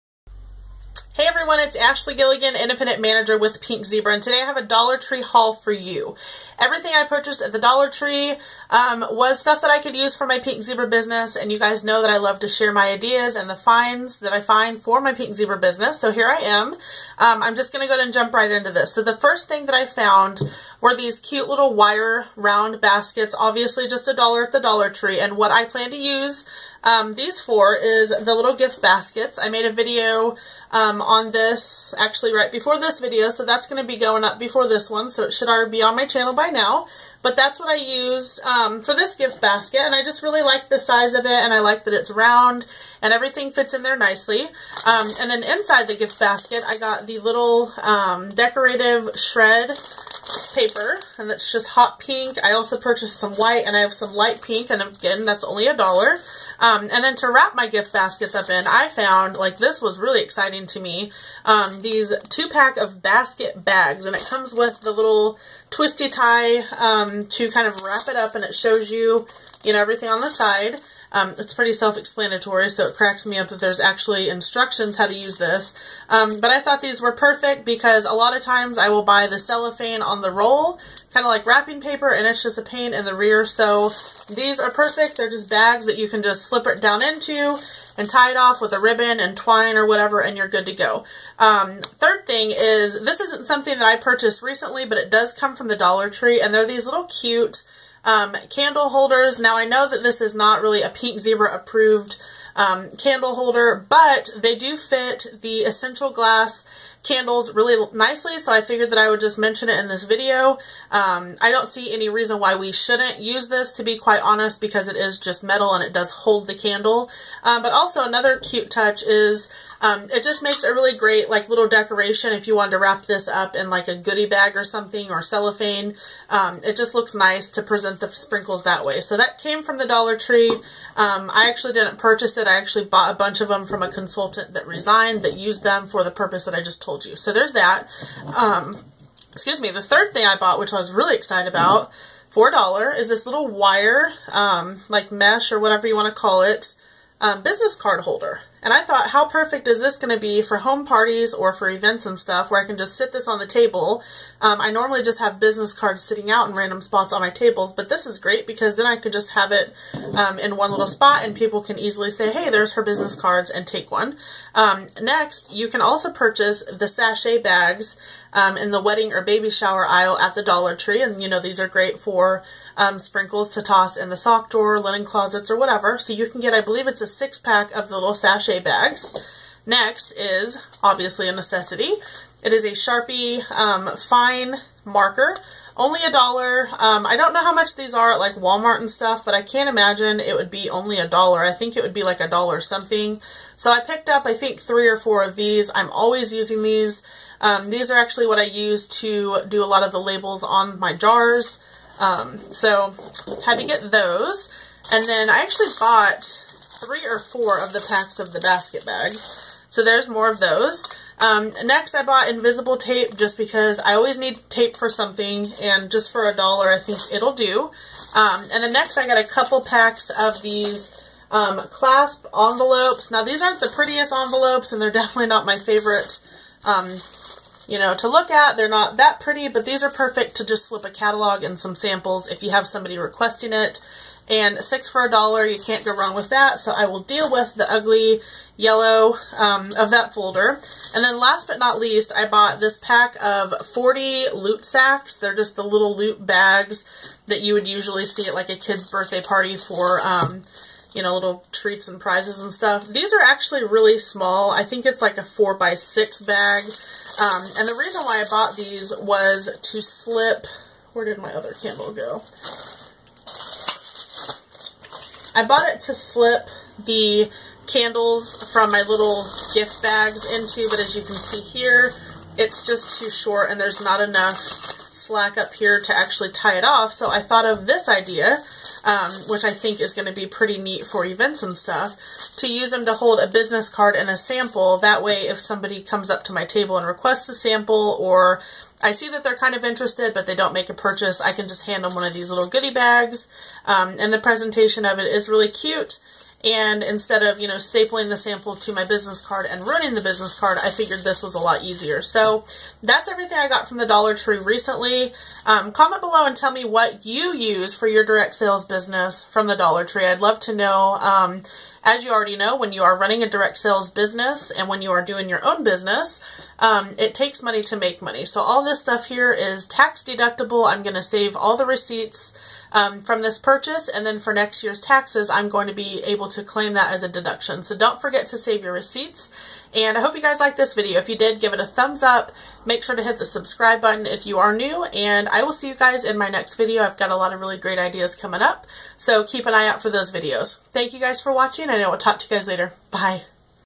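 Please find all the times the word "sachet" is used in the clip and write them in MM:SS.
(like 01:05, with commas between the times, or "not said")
02:46, 02:58.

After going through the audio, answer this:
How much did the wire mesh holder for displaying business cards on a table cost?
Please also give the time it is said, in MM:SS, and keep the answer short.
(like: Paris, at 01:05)
$4, at 02:22.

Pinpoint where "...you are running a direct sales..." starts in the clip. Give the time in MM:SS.
05:12.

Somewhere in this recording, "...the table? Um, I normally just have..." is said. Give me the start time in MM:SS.
02:33.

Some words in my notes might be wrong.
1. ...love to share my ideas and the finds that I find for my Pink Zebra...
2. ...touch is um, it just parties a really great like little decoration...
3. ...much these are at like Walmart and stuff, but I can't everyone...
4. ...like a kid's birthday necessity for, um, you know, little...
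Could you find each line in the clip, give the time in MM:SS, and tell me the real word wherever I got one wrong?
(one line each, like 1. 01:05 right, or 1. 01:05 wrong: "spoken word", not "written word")
1. 00:12 right
2. 01:58 wrong: "makes", not "parties"
3. 03:07 wrong: "imagine", not "everyone"
4. 04:08 wrong: "party", not "necessity".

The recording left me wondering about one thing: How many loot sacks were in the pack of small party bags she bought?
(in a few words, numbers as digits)
40.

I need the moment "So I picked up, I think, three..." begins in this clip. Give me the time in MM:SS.
03:13.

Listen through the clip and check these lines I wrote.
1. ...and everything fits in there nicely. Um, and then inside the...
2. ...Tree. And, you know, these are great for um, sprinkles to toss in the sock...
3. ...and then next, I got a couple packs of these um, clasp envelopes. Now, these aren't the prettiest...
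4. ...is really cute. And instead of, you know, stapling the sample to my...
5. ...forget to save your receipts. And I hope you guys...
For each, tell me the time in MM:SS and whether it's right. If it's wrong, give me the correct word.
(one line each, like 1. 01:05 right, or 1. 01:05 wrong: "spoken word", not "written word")
1. 00:43 right
2. 02:50 right
3. 03:38 right
4. 04:55 right
5. 05:27 right.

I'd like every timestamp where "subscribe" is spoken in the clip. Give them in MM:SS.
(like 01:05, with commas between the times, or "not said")
05:33.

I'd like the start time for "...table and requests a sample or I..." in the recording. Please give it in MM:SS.
04:46.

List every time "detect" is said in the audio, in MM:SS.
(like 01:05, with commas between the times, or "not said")
not said.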